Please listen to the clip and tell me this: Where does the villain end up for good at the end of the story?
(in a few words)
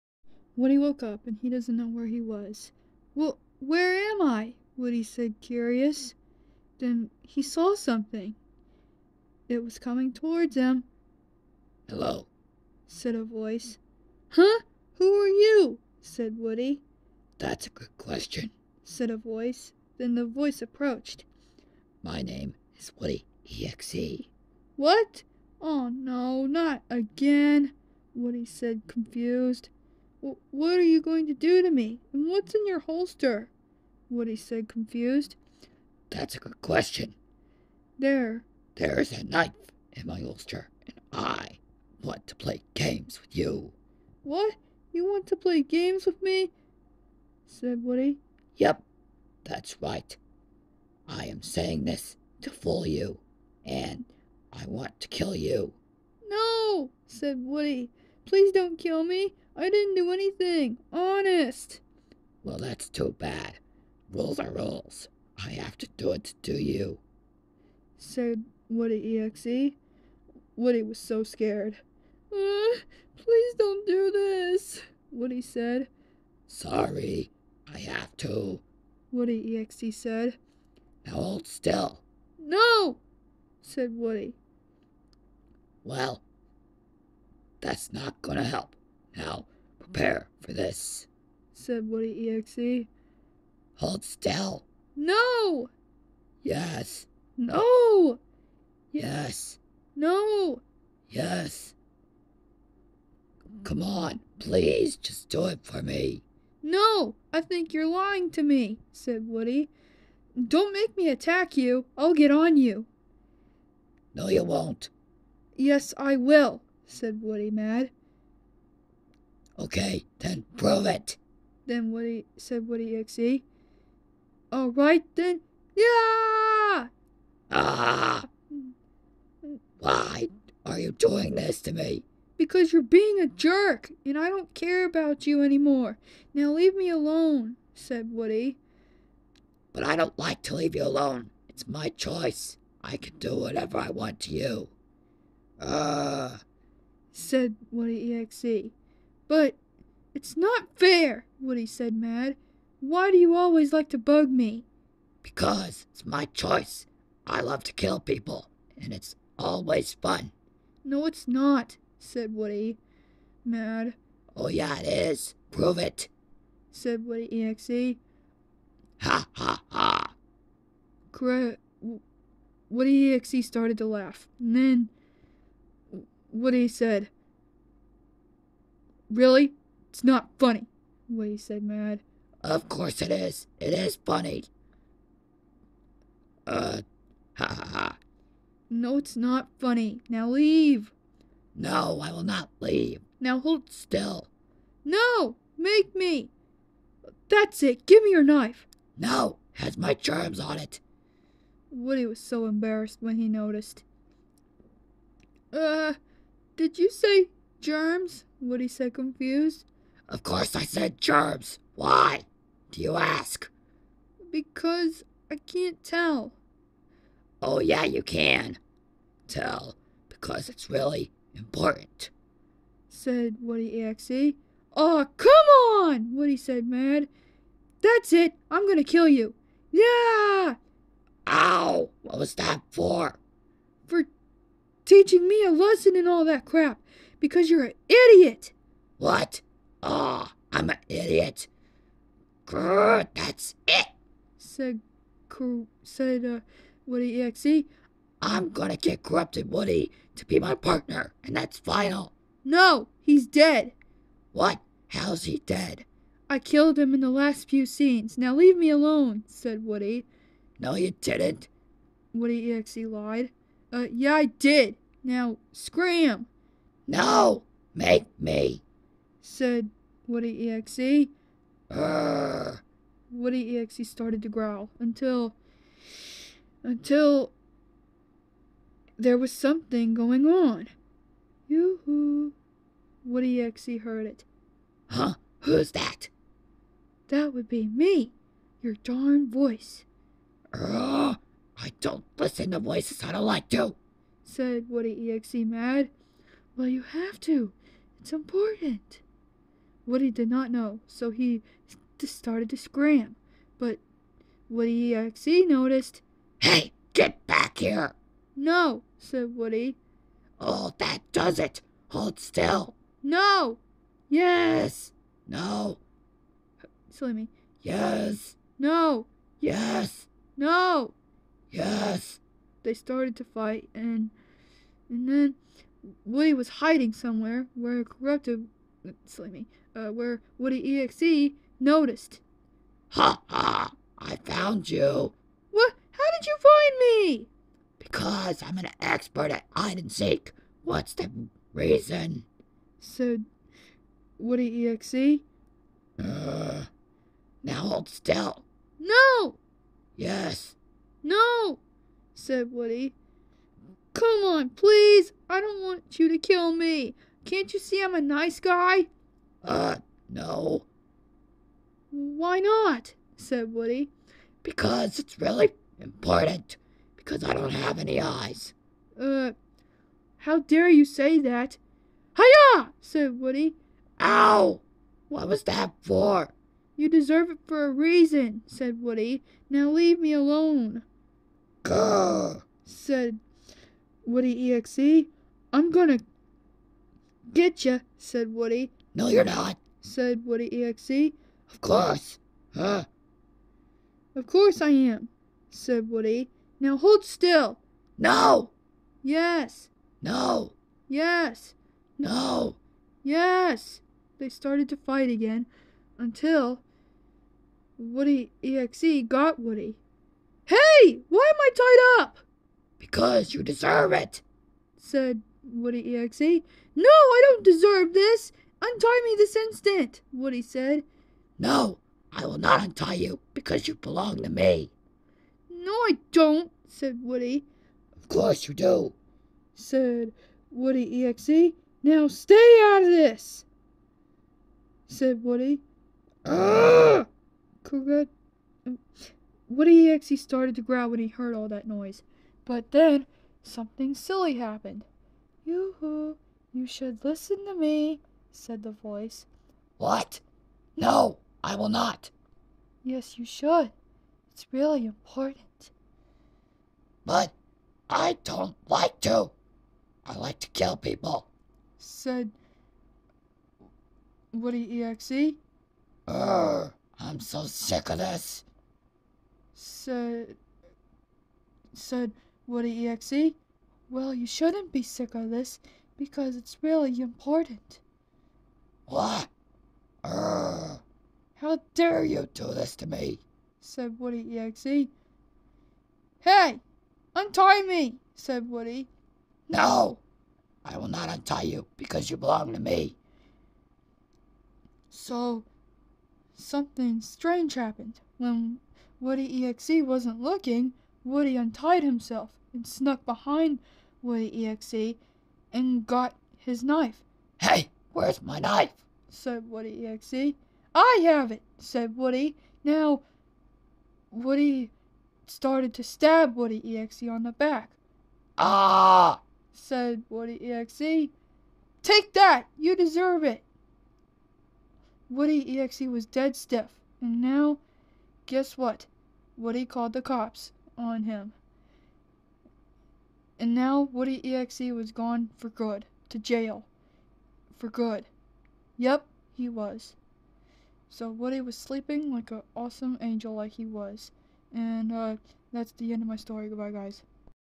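Jail.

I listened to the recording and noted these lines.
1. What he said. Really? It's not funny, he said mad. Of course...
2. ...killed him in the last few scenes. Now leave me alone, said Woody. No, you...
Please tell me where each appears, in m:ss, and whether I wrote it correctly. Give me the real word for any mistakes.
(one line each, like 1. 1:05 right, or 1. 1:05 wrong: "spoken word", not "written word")
1. 2:56 right
2. 4:16 right.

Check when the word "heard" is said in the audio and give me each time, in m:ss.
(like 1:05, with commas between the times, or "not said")
4:43, 7:21.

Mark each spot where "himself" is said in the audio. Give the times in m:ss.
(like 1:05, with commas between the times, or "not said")
8:21.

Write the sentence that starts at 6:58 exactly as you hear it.
Untie me this instant, Woody said.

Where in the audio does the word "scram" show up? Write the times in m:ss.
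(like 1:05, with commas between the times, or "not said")
4:25, 5:02.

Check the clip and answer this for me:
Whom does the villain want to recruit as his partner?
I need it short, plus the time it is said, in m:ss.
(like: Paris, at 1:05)
Corrupted Woody, at 4:08.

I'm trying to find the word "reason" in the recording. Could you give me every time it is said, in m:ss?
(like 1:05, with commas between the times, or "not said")
5:41, 6:17.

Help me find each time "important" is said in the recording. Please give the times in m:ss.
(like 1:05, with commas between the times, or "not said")
3:41, 4:58, 6:05, 7:34, 7:56.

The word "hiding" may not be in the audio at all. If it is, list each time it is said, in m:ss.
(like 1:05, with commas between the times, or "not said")
5:26.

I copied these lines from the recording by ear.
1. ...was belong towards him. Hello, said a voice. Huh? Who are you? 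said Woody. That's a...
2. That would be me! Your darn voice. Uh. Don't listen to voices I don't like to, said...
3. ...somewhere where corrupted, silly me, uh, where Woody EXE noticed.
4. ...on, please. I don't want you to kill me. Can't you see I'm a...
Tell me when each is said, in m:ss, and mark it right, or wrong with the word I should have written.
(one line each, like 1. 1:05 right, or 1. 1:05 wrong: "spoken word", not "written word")
1. 0:09 wrong: "coming", not "belong"
2. 4:47 right
3. 5:26 right
4. 5:54 right.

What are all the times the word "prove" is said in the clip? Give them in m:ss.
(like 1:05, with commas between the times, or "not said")
2:00, 2:45.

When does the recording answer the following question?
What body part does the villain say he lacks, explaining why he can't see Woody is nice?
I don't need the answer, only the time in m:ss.
6:07.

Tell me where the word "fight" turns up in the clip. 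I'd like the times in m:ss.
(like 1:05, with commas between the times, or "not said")
5:23, 6:44.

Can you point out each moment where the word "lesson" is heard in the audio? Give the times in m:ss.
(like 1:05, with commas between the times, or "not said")
3:55.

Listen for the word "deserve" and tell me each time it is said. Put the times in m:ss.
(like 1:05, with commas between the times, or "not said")
6:16, 6:53, 6:57, 8:42.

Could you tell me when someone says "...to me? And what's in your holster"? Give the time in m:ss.
0:31.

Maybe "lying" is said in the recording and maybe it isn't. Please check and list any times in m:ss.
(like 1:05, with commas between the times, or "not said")
1:47.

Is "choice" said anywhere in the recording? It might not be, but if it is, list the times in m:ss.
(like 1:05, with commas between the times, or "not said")
2:21, 2:36.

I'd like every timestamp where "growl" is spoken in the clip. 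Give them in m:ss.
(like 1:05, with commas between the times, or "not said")
4:34, 7:20.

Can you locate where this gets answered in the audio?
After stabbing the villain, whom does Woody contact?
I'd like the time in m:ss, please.
8:49.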